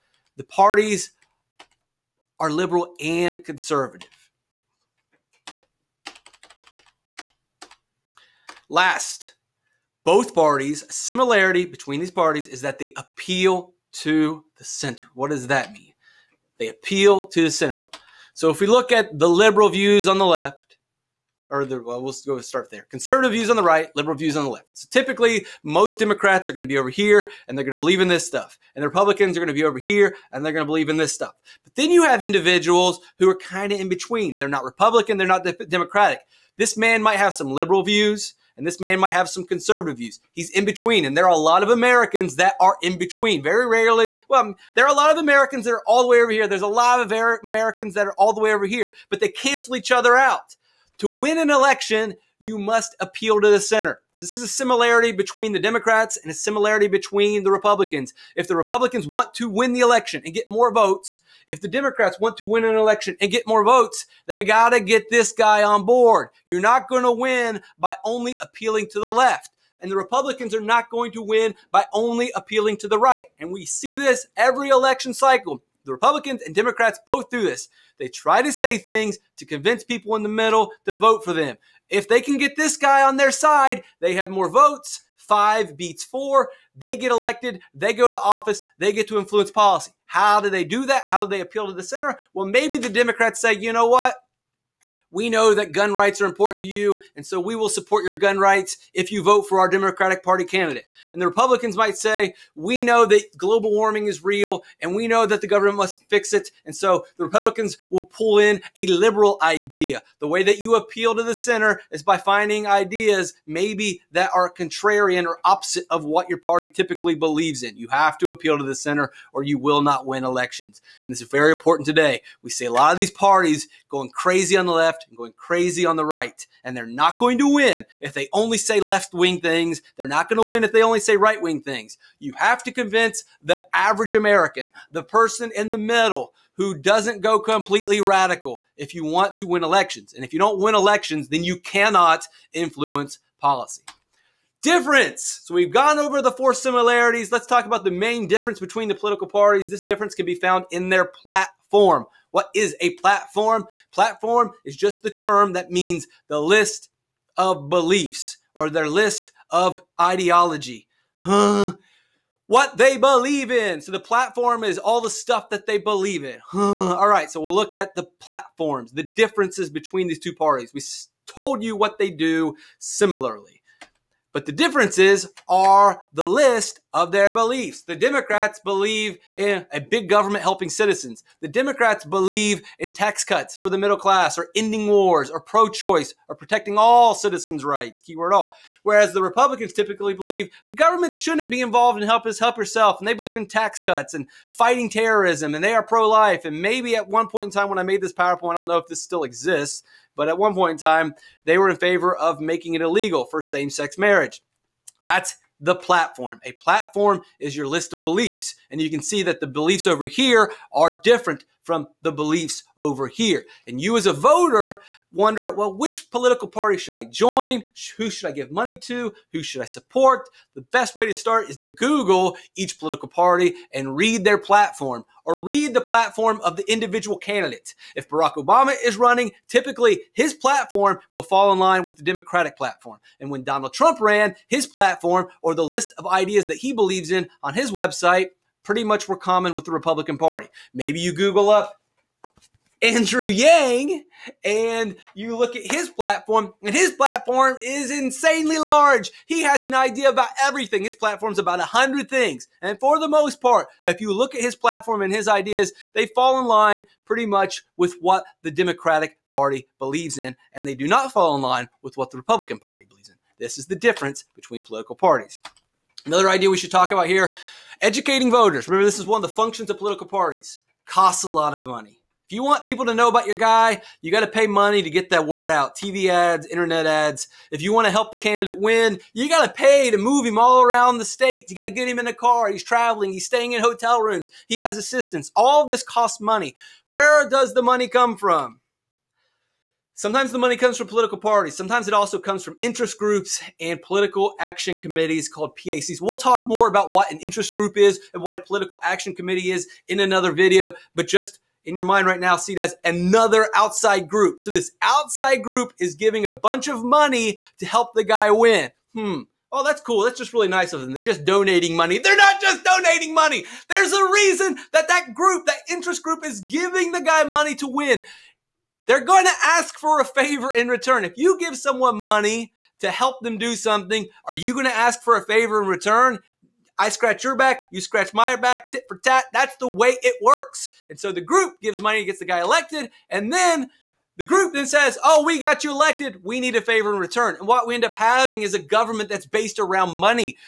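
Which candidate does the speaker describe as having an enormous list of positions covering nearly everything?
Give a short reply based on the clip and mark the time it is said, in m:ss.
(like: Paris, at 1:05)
Andrew Yang, at 4:02.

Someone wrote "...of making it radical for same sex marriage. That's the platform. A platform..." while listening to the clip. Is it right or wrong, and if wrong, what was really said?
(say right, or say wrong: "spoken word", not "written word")
wrong: "illegal", not "radical".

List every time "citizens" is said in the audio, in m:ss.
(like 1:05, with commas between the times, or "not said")
3:00, 3:07.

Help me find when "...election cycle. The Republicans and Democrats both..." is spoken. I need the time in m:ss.
1:14.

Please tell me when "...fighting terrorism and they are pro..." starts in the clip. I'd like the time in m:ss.
3:14.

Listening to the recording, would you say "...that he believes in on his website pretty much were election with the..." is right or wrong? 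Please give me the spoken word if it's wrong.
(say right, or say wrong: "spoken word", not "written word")
wrong: "common", not "election".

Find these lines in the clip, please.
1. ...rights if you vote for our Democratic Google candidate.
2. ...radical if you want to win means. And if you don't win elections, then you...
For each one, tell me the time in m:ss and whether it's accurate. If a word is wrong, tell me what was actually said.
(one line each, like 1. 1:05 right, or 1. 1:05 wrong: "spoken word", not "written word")
1. 1:38 wrong: "Party", not "Google"
2. 2:18 wrong: "elections", not "means".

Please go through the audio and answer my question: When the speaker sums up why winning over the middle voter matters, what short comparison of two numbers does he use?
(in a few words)
Five beats four.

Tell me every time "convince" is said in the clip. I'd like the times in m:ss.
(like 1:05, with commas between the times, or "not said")
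1:19, 2:12.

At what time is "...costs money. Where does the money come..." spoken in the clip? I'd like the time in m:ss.
4:45.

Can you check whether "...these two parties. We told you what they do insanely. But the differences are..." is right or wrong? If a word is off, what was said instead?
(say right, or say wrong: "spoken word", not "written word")
wrong: "similarly", not "insanely".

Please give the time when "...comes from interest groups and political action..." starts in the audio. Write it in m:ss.
4:52.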